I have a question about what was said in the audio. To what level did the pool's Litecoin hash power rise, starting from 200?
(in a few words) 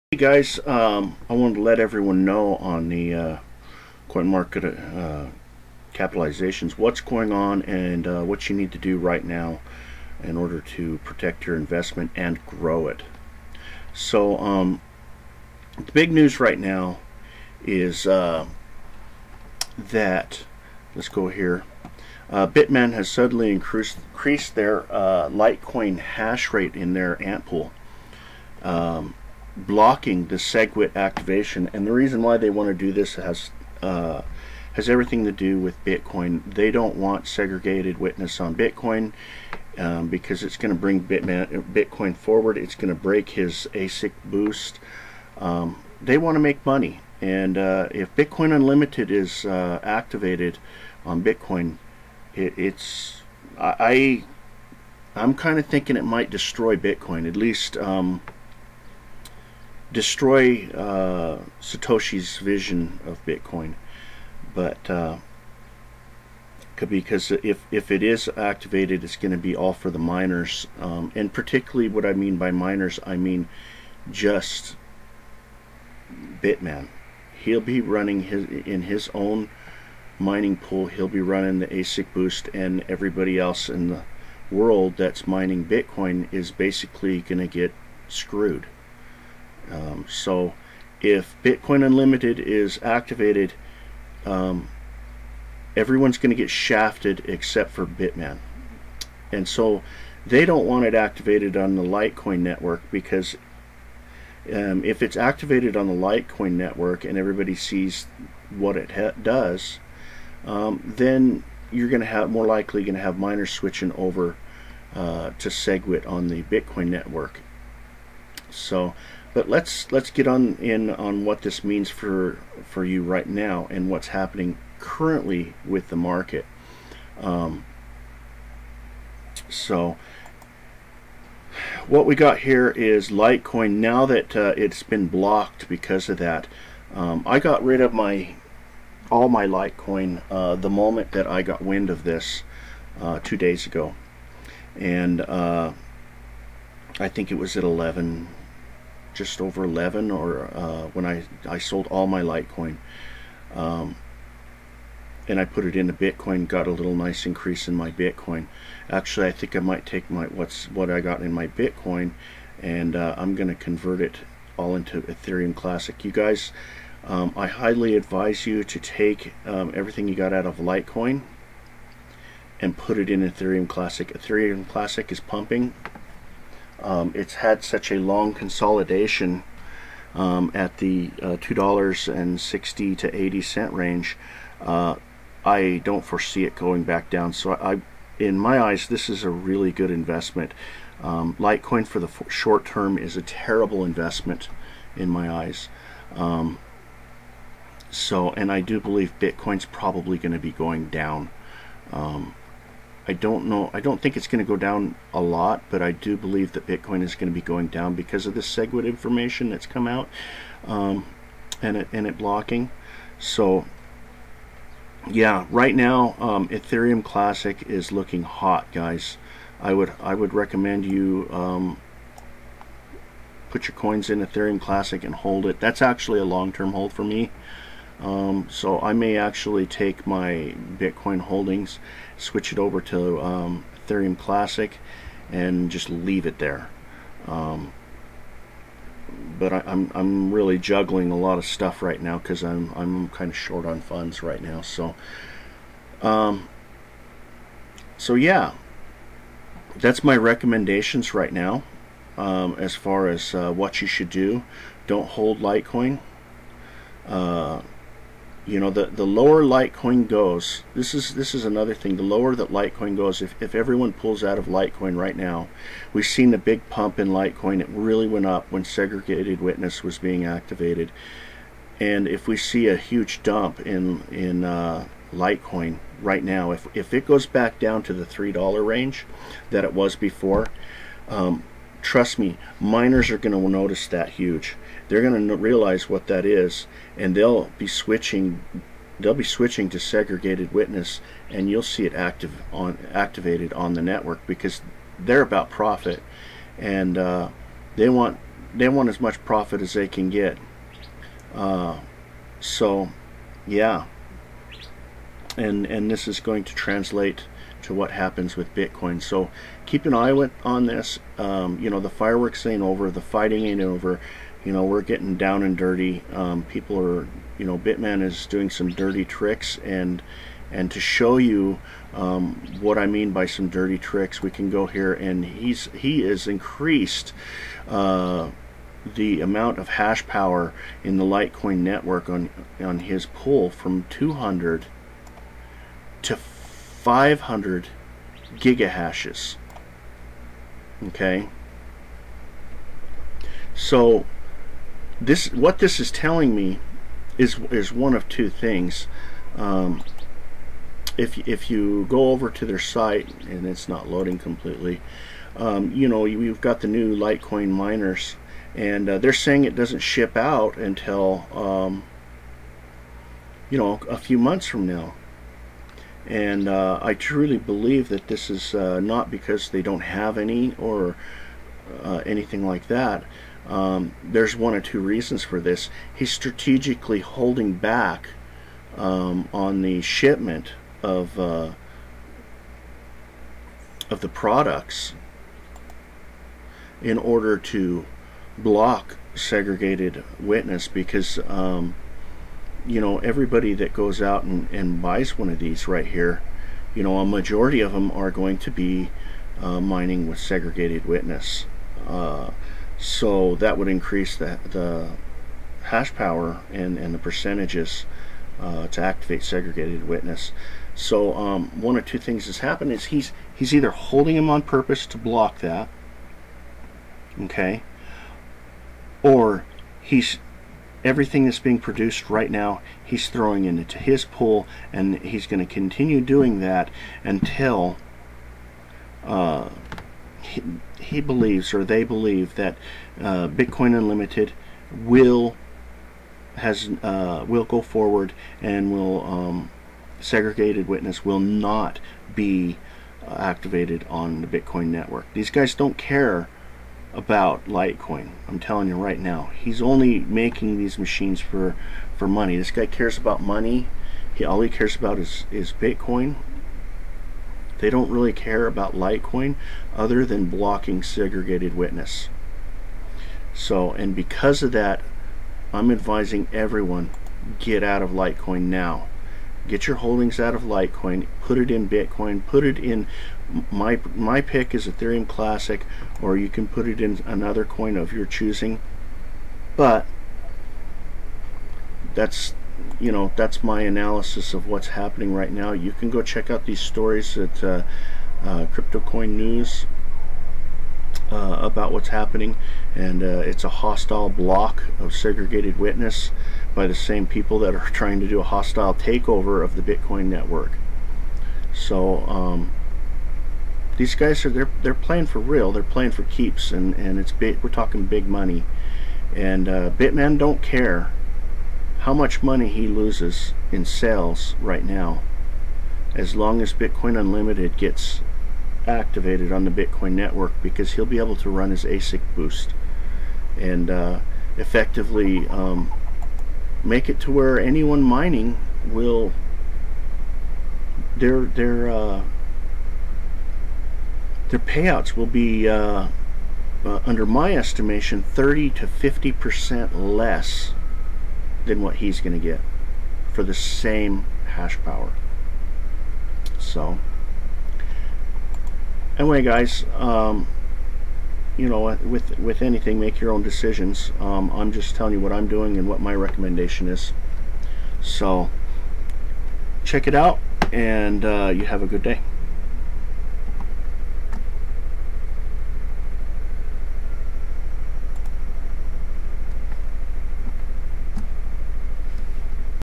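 500 gigahashes.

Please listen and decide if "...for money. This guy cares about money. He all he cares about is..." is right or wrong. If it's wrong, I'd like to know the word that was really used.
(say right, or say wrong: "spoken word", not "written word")
right.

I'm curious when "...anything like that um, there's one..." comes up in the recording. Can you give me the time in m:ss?
6:12.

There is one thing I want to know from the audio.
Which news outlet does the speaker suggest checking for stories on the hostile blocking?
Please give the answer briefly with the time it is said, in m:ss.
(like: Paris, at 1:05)
CryptoCoin News, at 8:08.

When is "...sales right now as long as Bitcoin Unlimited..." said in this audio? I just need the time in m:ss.
8:33.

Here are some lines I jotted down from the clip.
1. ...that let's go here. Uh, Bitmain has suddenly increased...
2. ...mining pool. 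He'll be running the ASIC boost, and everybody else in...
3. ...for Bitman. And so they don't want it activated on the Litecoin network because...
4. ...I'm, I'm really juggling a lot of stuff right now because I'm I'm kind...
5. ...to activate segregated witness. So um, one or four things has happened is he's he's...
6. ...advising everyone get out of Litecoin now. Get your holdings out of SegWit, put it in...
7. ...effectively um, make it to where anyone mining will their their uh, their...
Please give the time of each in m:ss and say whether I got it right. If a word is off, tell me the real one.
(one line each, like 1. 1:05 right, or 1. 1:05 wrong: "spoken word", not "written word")
1. 0:19 right
2. 1:20 right
3. 1:37 right
4. 3:59 right
5. 6:48 wrong: "two", not "four"
6. 7:45 wrong: "Litecoin", not "SegWit"
7. 8:44 right.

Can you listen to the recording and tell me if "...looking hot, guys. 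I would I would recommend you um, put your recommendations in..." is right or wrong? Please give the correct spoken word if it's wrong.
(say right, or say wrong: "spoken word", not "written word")
wrong: "coins", not "recommendations".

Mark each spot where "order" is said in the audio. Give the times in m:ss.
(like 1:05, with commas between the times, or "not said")
0:10, 6:26.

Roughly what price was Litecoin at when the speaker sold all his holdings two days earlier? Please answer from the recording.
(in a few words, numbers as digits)
just over 11.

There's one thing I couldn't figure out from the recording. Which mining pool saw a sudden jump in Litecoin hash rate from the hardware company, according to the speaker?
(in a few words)
AntPool.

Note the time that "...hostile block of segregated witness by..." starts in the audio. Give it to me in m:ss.
8:13.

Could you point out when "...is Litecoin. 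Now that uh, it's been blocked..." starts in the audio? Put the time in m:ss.
2:12.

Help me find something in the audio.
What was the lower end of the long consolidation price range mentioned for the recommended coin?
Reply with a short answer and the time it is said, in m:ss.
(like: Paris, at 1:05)
$2.60, at 3:01.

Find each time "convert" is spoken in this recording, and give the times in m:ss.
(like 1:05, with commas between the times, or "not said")
2:43.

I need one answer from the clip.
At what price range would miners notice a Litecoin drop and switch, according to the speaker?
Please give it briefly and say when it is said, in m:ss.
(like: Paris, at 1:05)
three dollar range, at 4:38.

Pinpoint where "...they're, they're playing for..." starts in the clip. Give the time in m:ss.
8:24.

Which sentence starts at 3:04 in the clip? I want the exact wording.
Uh, I don't foresee it going back down.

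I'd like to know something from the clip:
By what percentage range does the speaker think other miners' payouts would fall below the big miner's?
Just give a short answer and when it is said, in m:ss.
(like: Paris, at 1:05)
30 to 50 percent, at 8:58.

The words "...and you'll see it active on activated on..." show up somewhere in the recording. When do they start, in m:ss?
4:51.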